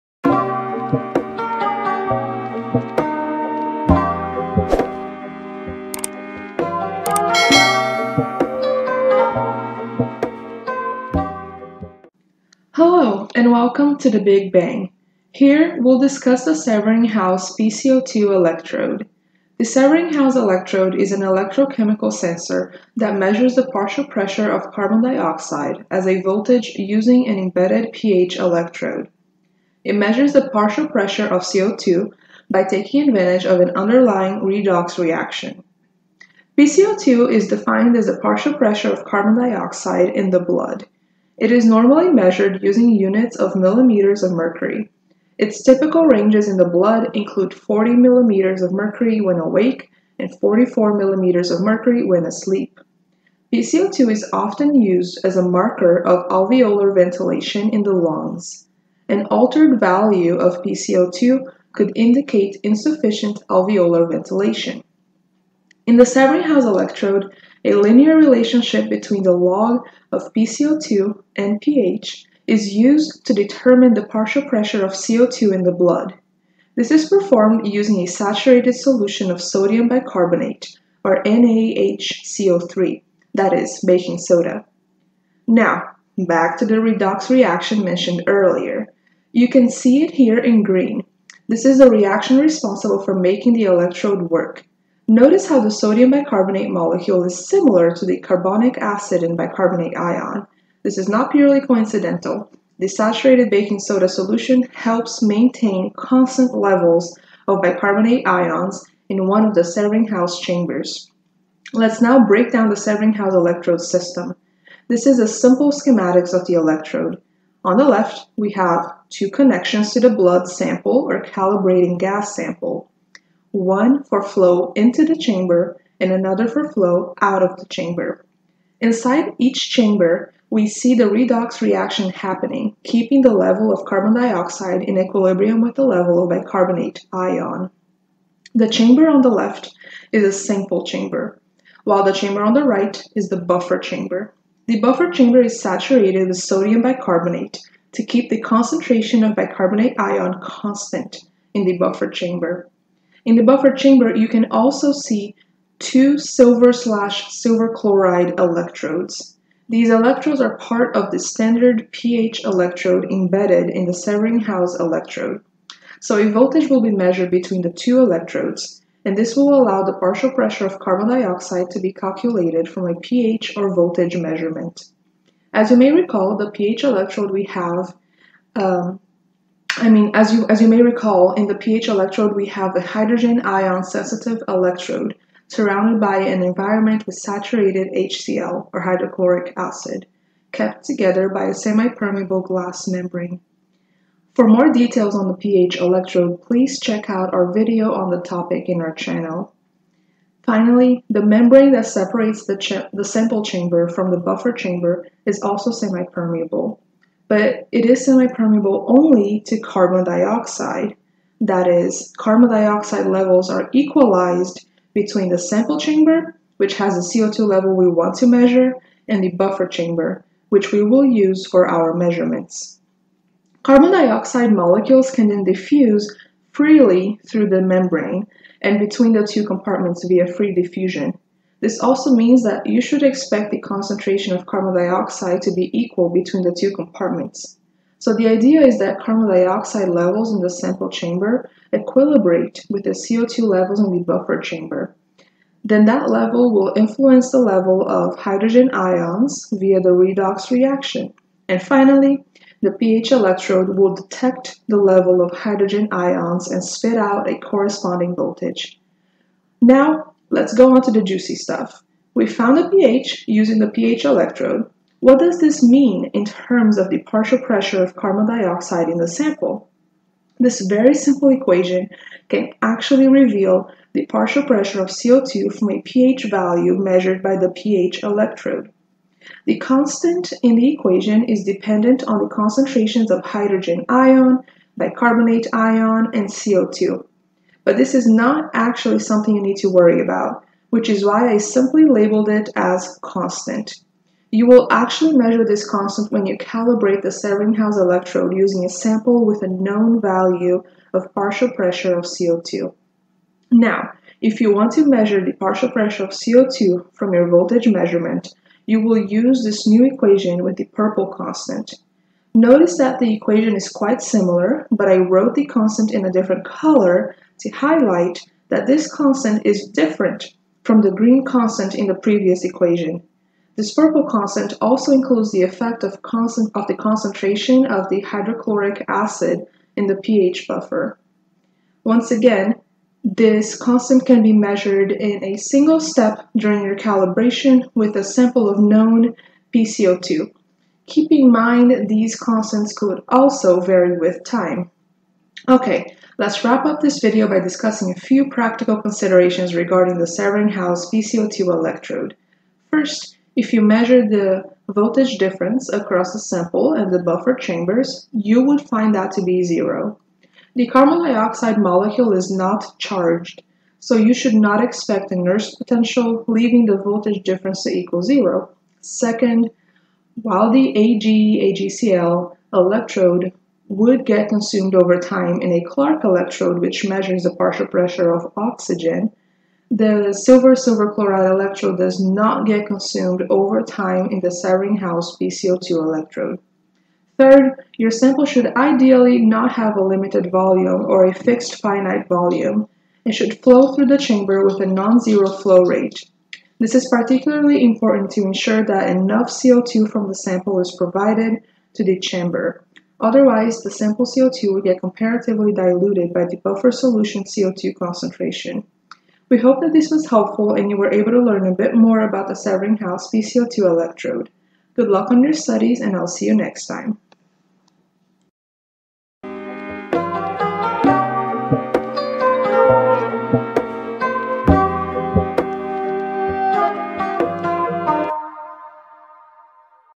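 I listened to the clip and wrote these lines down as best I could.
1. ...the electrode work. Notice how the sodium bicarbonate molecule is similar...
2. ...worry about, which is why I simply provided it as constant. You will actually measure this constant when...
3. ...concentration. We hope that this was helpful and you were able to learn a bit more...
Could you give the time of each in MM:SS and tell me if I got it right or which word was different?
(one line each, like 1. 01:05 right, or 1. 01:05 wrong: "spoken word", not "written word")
1. 01:33 right
2. 04:49 wrong: "labeled", not "provided"
3. 06:47 right.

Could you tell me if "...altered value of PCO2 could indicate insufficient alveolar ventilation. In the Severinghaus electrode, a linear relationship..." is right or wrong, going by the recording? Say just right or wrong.
right.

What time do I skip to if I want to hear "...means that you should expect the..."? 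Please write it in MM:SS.
03:52.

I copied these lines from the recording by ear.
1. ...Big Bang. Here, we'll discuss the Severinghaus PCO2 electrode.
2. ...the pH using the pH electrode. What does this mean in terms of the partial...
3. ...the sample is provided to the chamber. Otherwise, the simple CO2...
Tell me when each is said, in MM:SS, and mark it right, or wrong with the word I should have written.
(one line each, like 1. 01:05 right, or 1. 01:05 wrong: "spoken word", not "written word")
1. 00:14 right
2. 04:22 right
3. 06:40 wrong: "sample", not "simple".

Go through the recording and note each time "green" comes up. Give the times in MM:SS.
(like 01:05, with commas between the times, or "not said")
01:30, 05:20.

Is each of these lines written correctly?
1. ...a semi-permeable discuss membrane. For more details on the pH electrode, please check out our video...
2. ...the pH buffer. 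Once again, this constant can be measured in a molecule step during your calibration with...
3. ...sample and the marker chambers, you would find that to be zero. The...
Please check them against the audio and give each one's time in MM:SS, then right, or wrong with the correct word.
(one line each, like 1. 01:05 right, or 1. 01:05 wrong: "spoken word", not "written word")
1. 03:11 wrong: "glass", not "discuss"
2. 05:29 wrong: "single", not "molecule"
3. 05:56 wrong: "buffer", not "marker".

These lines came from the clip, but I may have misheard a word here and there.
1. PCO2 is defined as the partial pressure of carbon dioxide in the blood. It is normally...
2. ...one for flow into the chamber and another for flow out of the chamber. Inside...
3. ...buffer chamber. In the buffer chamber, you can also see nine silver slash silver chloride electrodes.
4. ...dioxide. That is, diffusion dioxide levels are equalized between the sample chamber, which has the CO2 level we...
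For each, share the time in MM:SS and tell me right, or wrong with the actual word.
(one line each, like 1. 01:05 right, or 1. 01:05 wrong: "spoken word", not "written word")
1. 00:36 right
2. 02:03 right
3. 02:31 wrong: "two", not "nine"
4. 03:30 wrong: "carbon", not "diffusion".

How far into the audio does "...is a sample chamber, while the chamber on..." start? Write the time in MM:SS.
02:20.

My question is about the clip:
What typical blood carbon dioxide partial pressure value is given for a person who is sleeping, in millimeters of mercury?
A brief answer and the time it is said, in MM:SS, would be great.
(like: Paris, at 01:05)
44, at 00:50.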